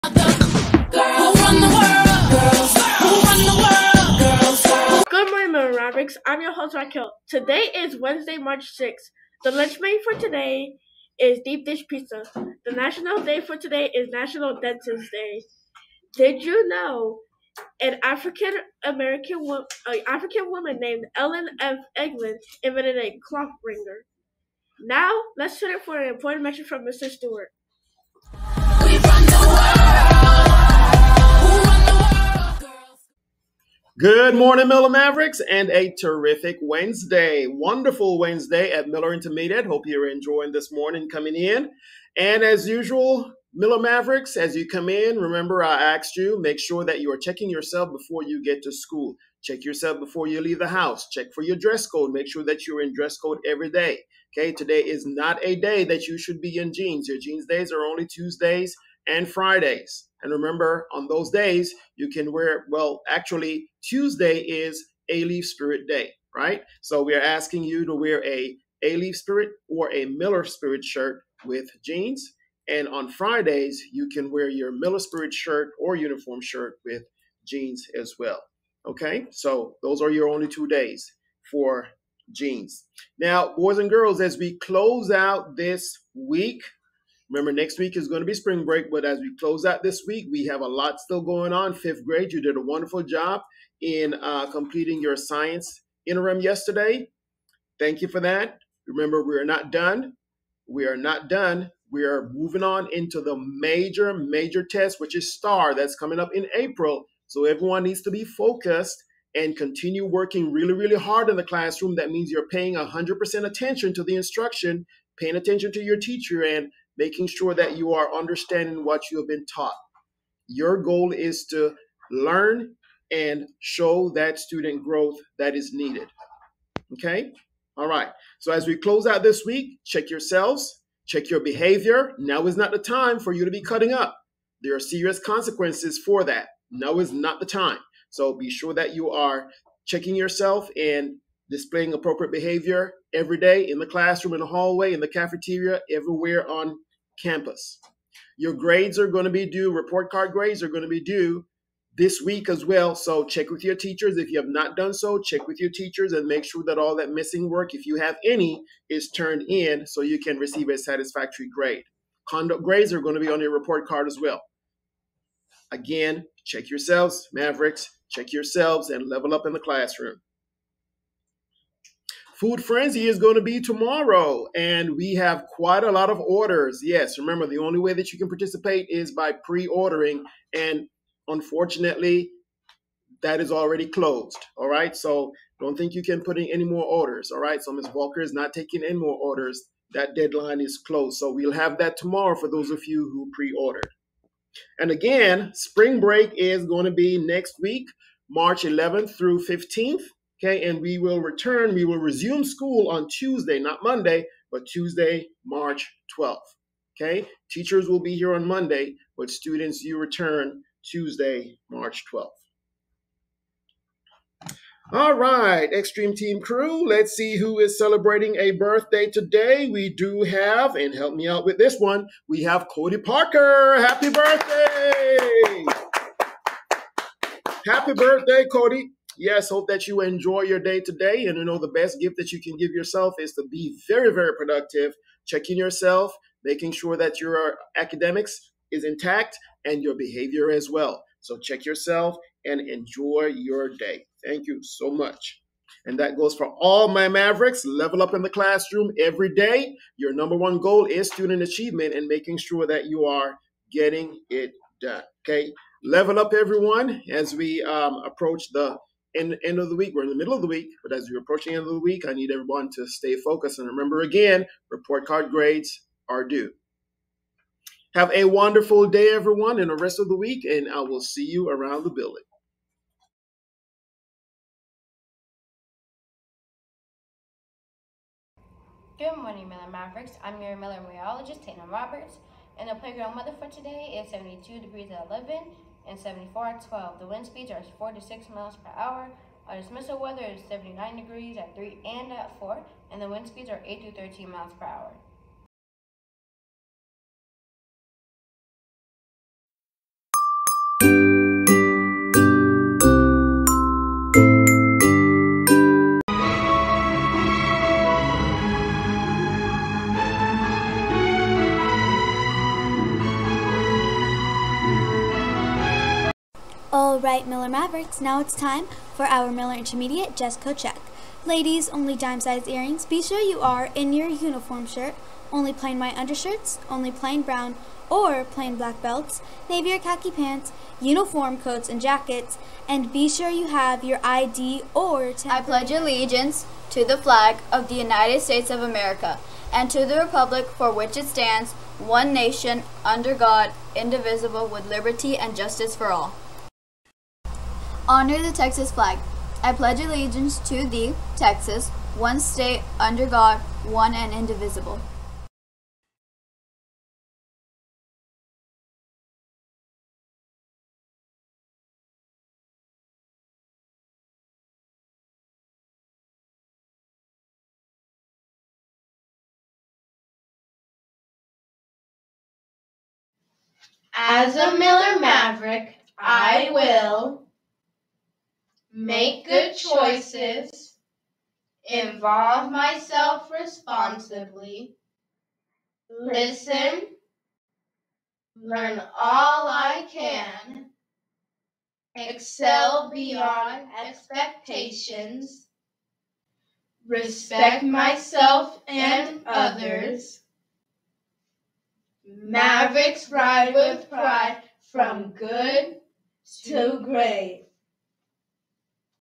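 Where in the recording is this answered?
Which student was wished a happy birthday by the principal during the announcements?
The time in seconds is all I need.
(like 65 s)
222 s.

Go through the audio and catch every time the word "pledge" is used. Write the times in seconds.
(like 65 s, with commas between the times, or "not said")
335 s, 349 s.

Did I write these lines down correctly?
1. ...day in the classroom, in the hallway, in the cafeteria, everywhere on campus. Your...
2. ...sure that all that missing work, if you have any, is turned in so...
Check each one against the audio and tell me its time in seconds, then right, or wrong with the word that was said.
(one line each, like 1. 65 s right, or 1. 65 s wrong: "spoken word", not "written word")
1. 143 s right
2. 156 s right.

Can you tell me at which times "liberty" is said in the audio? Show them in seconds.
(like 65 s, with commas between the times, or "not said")
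344 s.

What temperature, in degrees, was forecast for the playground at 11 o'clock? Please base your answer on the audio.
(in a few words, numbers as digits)
72.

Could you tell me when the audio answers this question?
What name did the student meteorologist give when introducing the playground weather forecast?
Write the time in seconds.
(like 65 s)
281 s.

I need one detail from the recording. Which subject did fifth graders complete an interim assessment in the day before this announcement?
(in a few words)
science.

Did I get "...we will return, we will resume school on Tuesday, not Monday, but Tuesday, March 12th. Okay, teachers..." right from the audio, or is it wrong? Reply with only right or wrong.
right.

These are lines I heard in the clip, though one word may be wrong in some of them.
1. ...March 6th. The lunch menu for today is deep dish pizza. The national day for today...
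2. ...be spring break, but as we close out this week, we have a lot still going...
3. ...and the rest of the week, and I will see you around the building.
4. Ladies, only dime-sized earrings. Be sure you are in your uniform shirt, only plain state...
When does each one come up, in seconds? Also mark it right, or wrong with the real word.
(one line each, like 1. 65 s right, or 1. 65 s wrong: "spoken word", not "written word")
1. 8 s right
2. 88 s right
3. 269 s right
4. 321 s wrong: "white", not "state".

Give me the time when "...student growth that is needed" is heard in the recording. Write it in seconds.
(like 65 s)
124 s.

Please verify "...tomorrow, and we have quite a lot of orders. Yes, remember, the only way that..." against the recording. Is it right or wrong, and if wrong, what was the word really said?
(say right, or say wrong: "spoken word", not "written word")
right.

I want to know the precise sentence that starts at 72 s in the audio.
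And on Fridays, you can wear your Miller Spirit shirt or uniform shirt with jeans as well.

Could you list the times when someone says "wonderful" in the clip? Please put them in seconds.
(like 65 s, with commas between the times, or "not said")
37 s, 92 s, 268 s.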